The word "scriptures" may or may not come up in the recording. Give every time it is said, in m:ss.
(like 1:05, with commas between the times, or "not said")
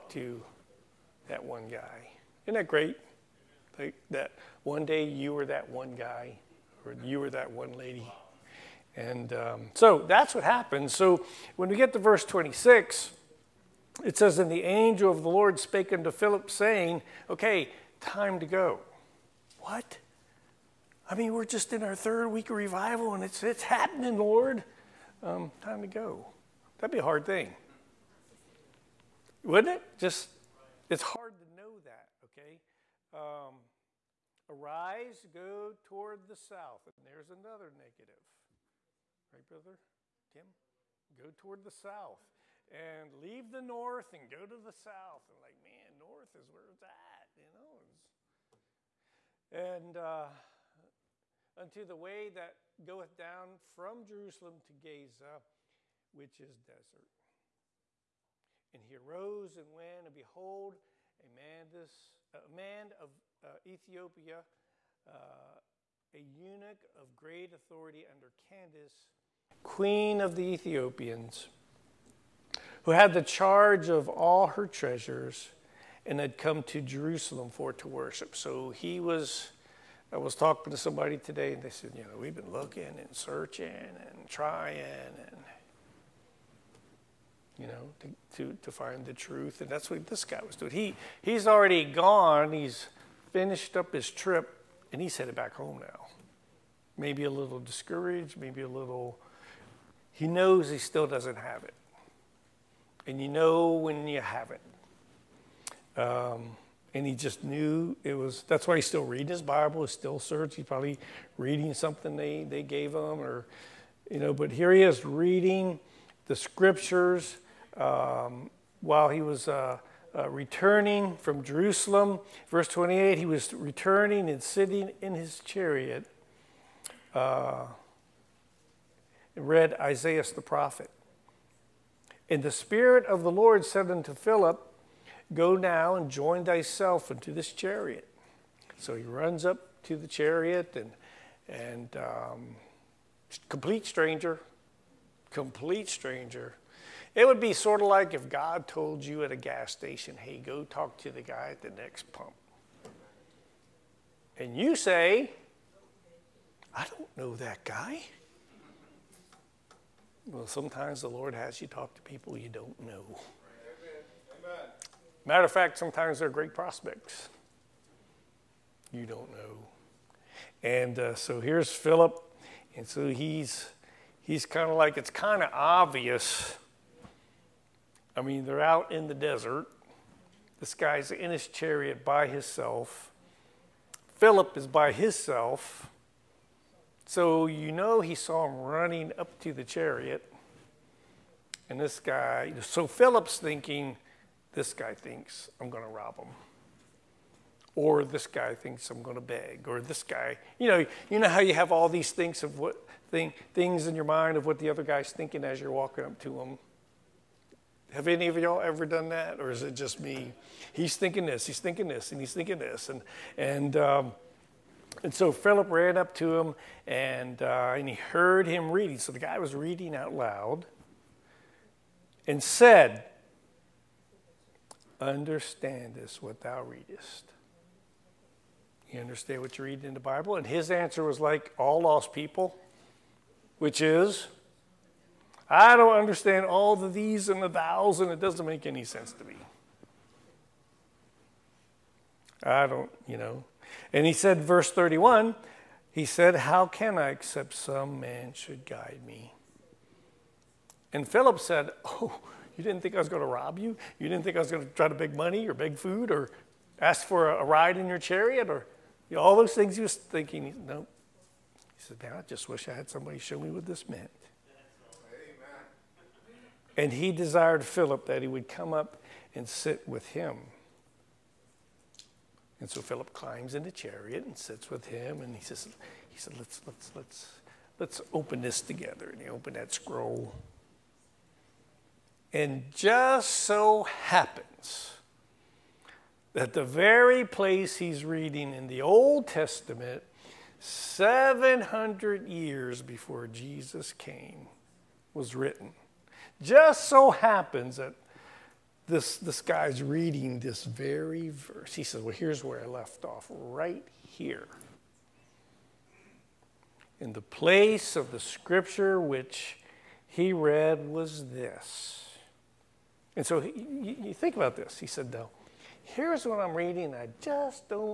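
1:56, 5:08.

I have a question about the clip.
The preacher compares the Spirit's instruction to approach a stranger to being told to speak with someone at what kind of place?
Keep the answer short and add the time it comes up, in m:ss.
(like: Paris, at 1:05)
A gas station, at 2:29.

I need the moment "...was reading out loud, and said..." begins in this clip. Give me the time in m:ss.
3:39.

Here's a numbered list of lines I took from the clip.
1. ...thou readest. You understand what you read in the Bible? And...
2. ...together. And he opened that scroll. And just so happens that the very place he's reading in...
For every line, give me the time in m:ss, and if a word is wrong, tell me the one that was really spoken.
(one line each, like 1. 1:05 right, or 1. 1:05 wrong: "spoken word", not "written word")
1. 3:46 right
2. 4:38 right.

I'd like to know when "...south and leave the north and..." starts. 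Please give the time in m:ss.
0:41.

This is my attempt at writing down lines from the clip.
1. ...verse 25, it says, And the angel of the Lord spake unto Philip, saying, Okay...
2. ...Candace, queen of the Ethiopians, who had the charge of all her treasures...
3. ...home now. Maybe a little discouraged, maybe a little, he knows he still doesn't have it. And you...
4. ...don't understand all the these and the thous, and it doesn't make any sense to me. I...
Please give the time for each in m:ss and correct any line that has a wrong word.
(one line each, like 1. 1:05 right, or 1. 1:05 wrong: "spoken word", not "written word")
1. 0:11 wrong: "26", not "25"
2. 1:08 right
3. 1:35 right
4. 3:55 right.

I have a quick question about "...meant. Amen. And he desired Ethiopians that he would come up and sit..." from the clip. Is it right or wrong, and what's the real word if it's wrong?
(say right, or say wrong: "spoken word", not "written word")
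wrong: "Philip", not "Ethiopians".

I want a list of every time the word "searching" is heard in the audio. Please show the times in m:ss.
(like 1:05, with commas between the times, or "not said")
1:23, 1:50.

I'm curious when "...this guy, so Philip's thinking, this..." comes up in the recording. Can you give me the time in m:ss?
3:11.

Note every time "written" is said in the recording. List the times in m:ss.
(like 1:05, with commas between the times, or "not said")
4:55.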